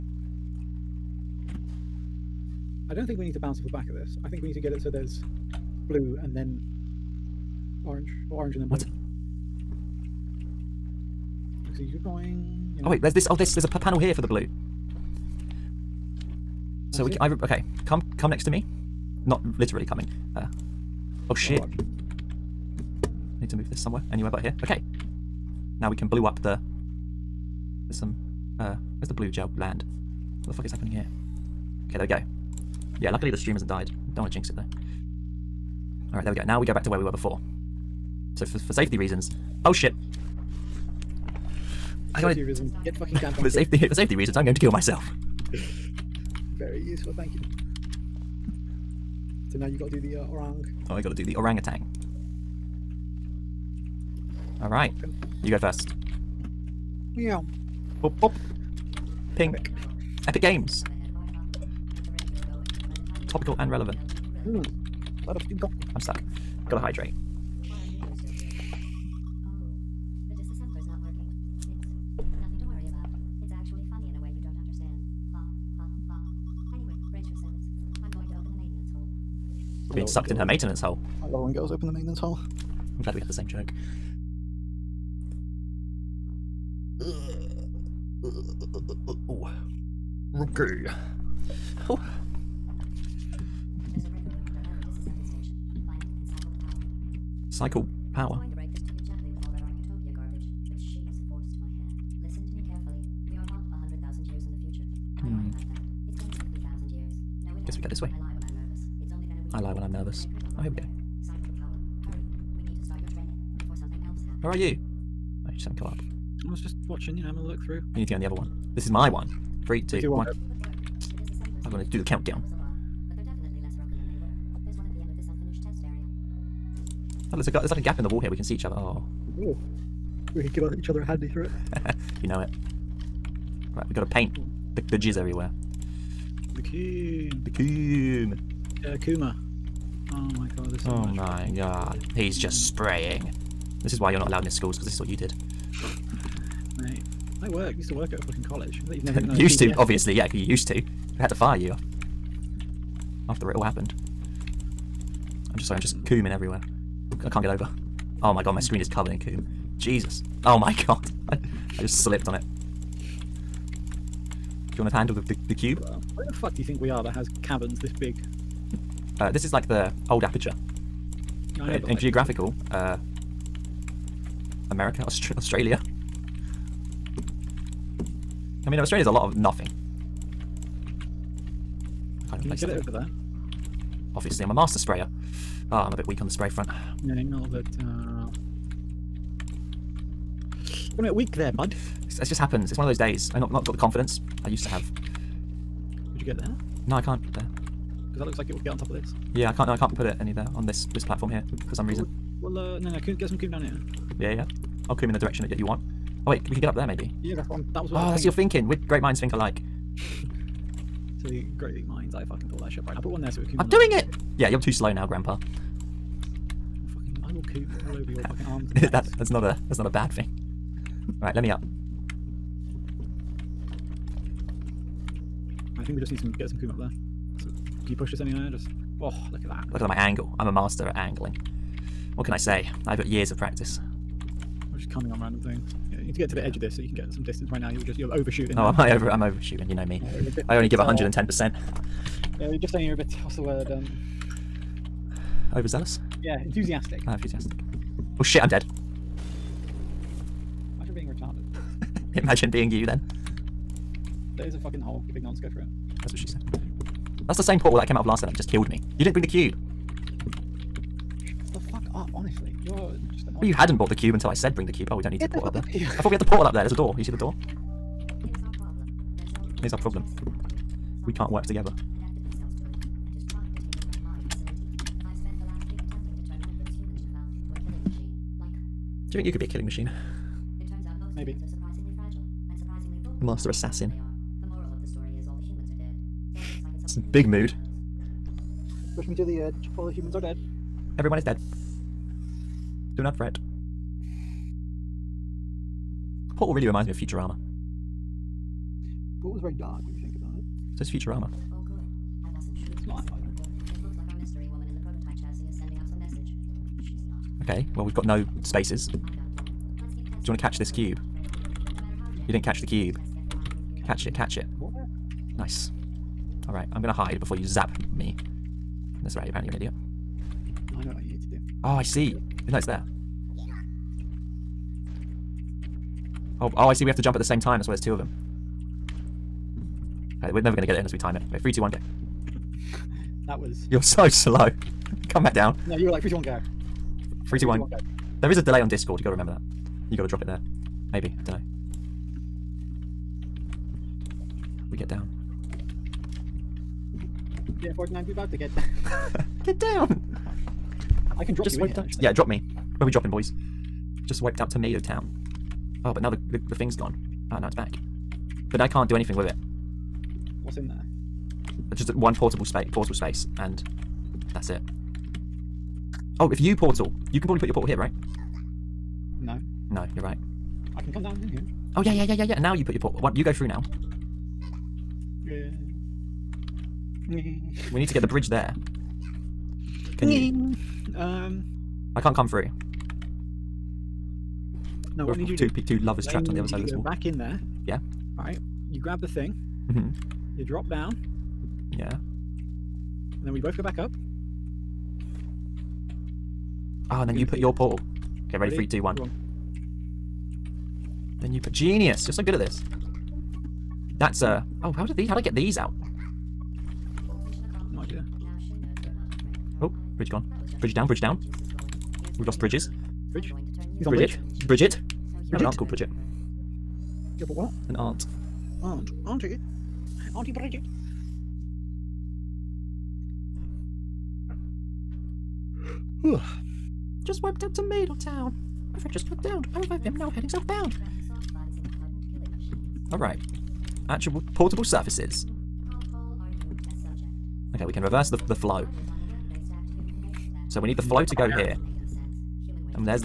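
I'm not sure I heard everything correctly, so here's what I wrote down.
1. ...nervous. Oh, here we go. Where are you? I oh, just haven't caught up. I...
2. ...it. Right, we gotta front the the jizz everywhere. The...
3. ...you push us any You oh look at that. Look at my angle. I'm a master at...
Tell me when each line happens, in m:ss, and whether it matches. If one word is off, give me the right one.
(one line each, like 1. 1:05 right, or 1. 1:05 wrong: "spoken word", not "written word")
1. 1:49 right
2. 2:12 wrong: "paint", not "front"
3. 3:47 wrong: "Just", not "You".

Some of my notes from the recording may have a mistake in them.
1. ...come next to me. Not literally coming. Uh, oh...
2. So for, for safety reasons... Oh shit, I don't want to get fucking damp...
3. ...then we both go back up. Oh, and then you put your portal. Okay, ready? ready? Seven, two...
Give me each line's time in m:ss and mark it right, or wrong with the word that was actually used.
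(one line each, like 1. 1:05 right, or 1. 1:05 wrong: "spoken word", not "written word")
1. 0:18 right
2. 0:38 right
3. 6:33 wrong: "Three", not "Seven".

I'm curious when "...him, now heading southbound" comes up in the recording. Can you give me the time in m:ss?
7:09.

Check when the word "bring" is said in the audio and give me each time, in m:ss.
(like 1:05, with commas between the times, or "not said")
4:19, 4:24.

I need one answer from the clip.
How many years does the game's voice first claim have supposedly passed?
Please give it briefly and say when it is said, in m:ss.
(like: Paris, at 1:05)
50,000, at 1:46.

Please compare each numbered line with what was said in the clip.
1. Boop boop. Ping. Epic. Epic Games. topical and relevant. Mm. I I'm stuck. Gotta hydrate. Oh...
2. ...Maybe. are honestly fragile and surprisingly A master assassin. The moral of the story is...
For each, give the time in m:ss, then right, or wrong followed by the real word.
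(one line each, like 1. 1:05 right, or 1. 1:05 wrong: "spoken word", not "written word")
1. 0:58 right
2. 4:41 wrong: "surprisingly", not "honestly".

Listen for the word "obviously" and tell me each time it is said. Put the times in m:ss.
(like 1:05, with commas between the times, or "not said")
2:29, 3:04.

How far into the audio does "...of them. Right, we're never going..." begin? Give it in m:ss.
5:27.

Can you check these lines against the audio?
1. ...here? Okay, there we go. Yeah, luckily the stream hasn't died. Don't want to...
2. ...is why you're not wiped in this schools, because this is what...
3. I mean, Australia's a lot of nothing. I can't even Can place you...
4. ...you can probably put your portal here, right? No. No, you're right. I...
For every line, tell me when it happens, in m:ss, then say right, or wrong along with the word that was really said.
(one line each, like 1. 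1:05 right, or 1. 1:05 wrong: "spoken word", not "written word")
1. 0:30 right
2. 2:23 wrong: "allowed", not "wiped"
3. 2:58 right
4. 6:07 right.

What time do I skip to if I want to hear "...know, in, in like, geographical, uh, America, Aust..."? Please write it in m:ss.
2:51.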